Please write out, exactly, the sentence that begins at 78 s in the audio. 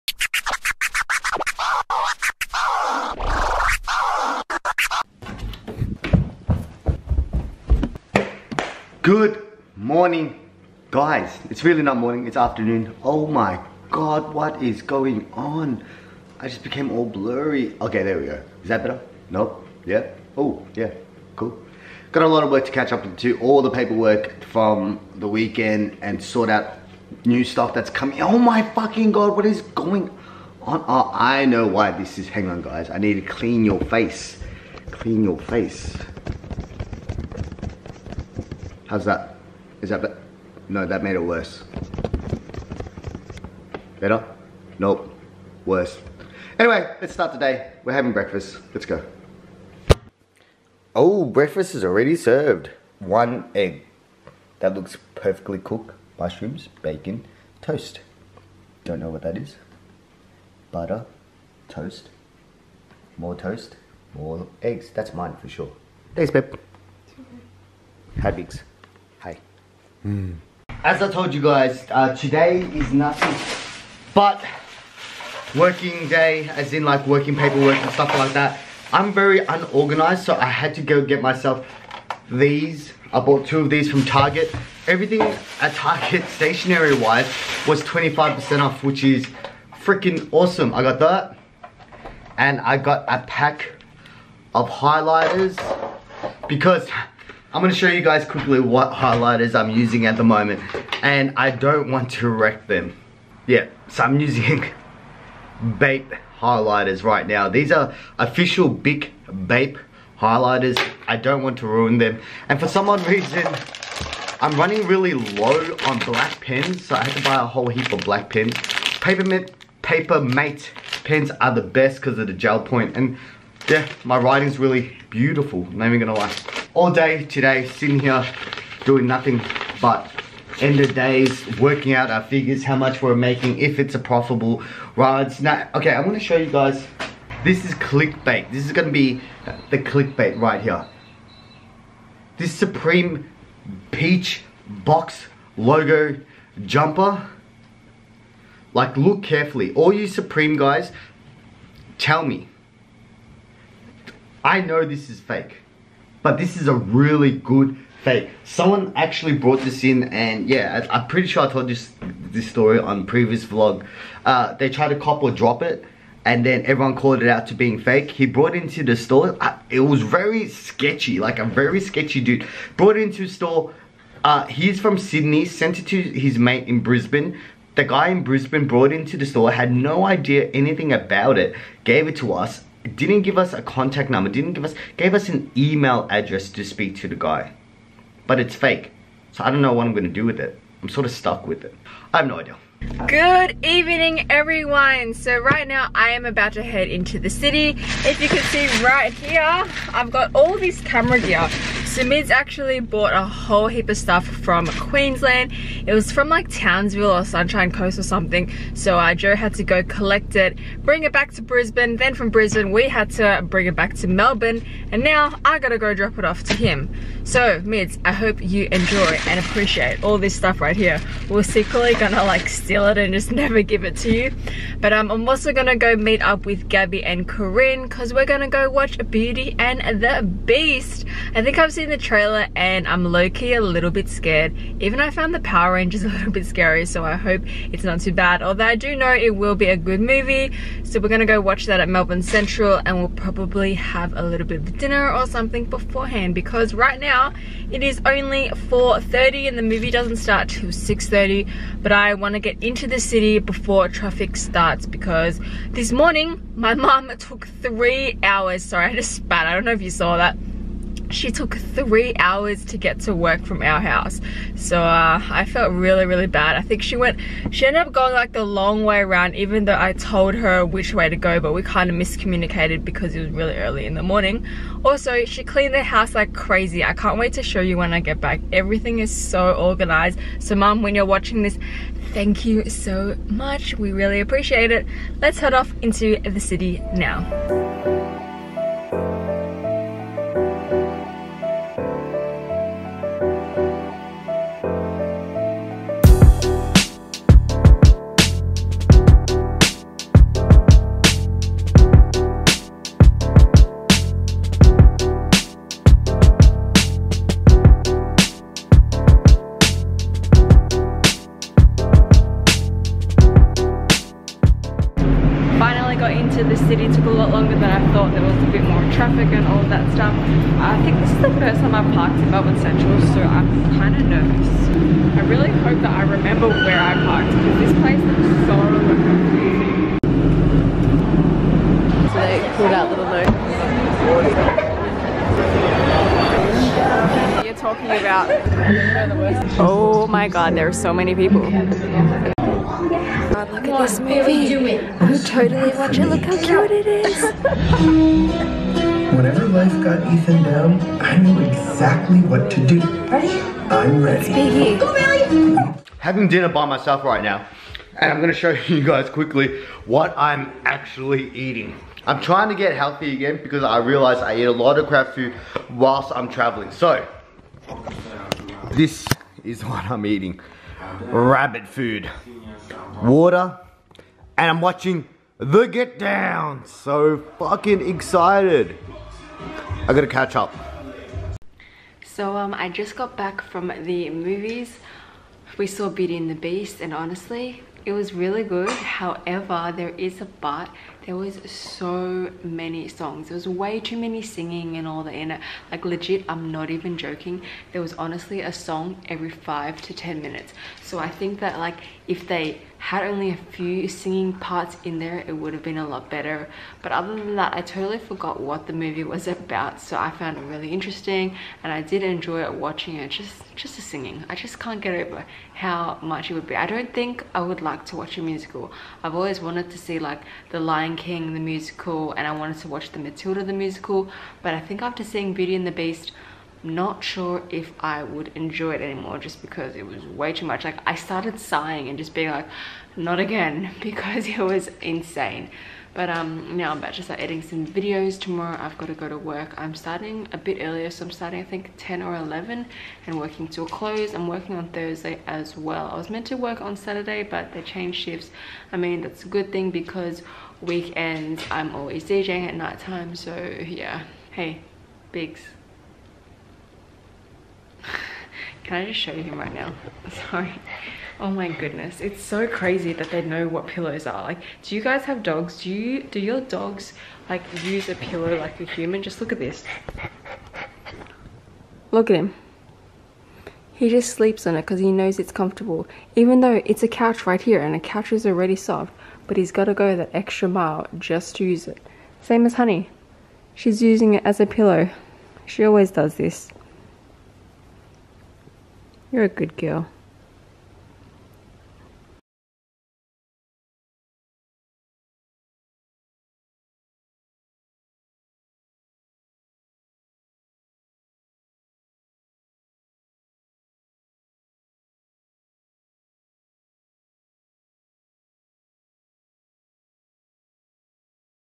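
I'm very unorganized, so I had to go get myself these.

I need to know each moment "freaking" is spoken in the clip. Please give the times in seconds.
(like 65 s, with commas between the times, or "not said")
89 s.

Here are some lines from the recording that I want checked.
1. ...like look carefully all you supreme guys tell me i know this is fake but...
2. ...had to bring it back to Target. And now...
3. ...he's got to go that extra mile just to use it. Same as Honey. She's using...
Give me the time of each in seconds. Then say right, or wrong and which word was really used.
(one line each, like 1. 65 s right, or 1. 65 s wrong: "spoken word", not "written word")
1. 148 s right
2. 212 s wrong: "Melbourne", not "Target"
3. 479 s right.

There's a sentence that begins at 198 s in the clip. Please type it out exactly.
If you can see right here, I've got all this camera gear.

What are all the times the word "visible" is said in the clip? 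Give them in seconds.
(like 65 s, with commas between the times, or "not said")
not said.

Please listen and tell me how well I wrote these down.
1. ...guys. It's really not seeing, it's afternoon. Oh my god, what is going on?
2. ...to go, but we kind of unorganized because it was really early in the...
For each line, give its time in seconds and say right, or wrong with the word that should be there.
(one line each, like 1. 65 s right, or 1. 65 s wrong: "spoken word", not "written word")
1. 10 s wrong: "morning", not "seeing"
2. 271 s wrong: "miscommunicated", not "unorganized".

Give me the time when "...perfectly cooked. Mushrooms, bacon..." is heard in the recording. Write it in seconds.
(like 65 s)
55 s.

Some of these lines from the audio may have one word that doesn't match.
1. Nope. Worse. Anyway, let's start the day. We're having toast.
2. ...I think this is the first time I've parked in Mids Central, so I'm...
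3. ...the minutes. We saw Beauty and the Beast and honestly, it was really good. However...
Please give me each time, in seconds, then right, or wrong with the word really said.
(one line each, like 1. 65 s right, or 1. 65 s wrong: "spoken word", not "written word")
1. 44 s wrong: "breakfast", not "toast"
2. 320 s wrong: "Melbourne", not "Mids"
3. 383 s wrong: "movies", not "minutes".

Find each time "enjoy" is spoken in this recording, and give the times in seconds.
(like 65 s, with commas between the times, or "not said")
218 s, 412 s, 428 s.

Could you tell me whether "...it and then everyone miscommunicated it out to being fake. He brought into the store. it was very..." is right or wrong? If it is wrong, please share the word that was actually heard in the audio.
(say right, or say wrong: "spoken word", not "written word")
wrong: "called", not "miscommunicated".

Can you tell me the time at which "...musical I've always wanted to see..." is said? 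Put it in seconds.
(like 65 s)
418 s.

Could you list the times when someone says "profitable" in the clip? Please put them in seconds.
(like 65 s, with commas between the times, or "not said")
133 s.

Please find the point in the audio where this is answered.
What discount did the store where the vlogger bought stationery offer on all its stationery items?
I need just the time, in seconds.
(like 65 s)
87 s.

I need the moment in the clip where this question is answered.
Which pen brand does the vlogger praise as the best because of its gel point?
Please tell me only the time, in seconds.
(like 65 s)
119 s.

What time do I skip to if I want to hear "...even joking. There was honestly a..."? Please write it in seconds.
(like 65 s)
396 s.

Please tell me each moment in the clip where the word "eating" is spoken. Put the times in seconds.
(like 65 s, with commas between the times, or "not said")
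361 s, 370 s.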